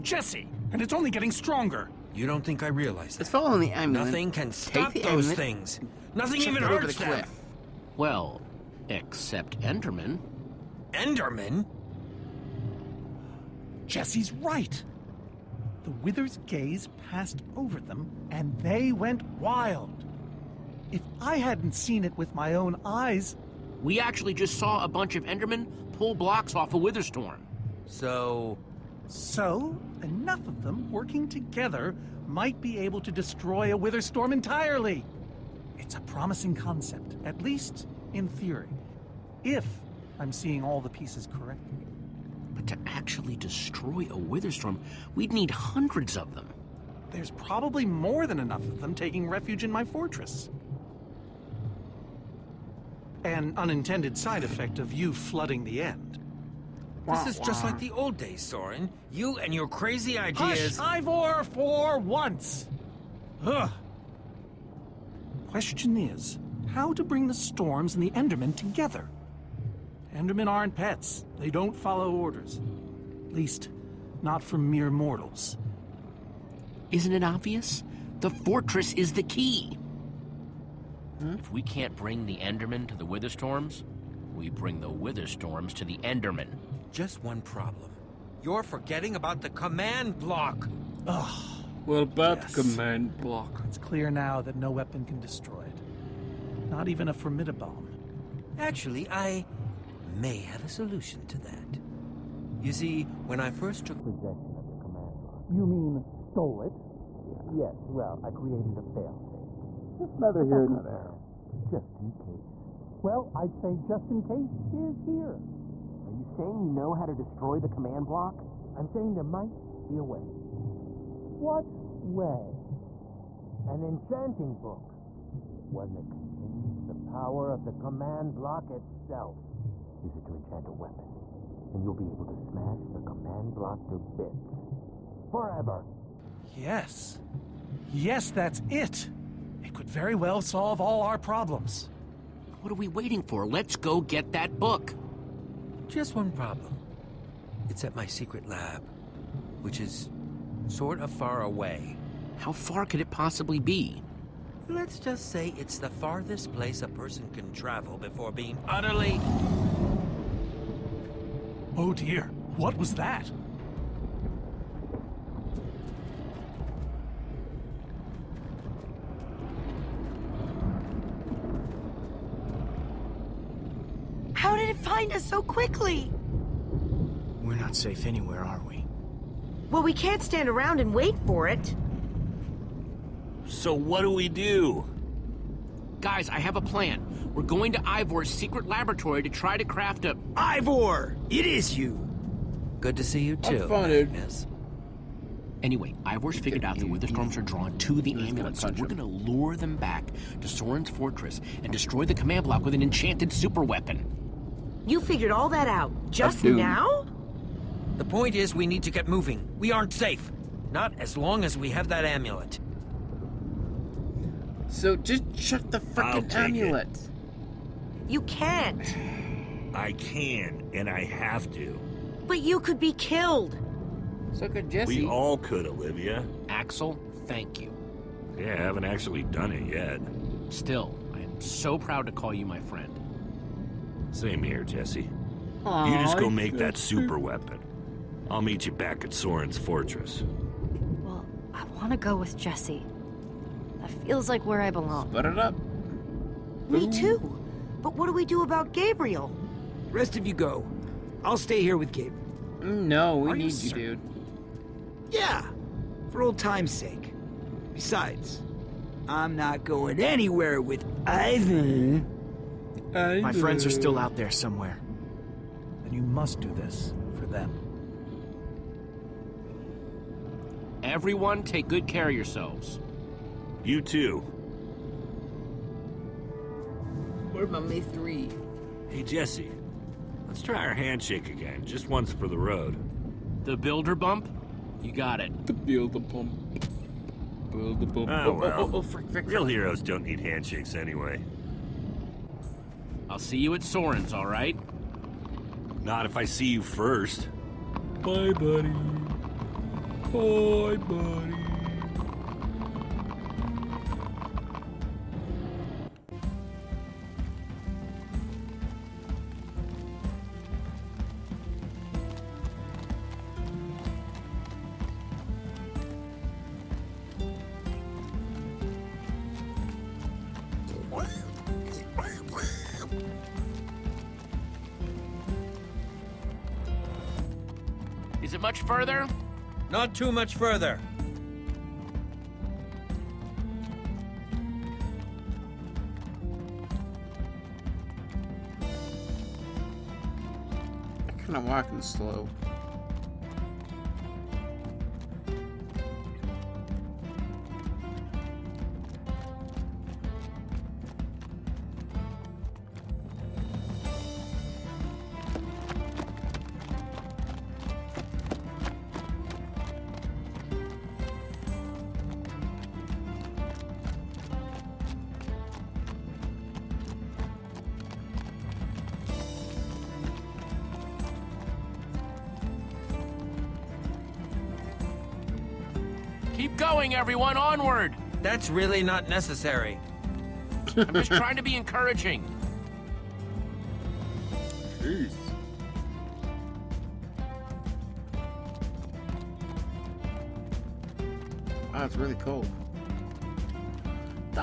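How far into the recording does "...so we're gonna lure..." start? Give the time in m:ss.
3:18.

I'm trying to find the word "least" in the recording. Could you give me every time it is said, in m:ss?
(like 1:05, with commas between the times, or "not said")
0:37, 1:13.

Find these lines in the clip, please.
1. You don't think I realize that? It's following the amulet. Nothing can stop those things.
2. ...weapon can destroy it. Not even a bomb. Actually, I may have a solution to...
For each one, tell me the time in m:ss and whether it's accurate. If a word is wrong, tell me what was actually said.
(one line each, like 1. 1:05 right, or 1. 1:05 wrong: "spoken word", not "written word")
1. 0:02 right
2. 1:34 right.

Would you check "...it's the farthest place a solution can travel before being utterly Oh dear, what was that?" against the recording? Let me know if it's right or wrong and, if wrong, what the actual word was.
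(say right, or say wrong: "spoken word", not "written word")
wrong: "person", not "solution".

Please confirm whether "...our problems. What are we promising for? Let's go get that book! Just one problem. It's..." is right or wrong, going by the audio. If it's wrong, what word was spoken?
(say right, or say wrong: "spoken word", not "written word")
wrong: "waiting", not "promising".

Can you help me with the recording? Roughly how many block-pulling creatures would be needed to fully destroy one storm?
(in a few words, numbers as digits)
hundreds.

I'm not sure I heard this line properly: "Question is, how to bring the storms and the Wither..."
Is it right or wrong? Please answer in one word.
wrong.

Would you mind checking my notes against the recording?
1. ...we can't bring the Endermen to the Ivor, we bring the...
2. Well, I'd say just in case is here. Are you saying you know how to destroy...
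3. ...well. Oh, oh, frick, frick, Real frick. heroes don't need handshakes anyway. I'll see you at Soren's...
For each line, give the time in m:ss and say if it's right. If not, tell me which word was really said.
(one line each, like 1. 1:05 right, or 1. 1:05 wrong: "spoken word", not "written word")
1. 1:21 wrong: "Witherstorms", not "Ivor"
2. 1:53 right
3. 4:48 right.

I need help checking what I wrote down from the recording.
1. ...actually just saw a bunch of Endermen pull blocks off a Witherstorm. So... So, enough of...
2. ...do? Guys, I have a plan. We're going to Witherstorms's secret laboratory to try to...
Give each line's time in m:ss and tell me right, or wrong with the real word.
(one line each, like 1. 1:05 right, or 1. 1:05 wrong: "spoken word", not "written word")
1. 0:23 right
2. 3:04 wrong: "Ivor", not "Witherstorms".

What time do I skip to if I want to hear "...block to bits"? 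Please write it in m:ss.
2:13.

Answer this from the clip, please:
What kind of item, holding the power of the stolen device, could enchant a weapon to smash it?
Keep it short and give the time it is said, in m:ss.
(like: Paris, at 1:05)
An enchanting book, at 2:03.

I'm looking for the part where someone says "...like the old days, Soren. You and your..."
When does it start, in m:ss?
0:57.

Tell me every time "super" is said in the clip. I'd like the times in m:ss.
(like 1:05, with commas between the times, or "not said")
3:23, 3:56.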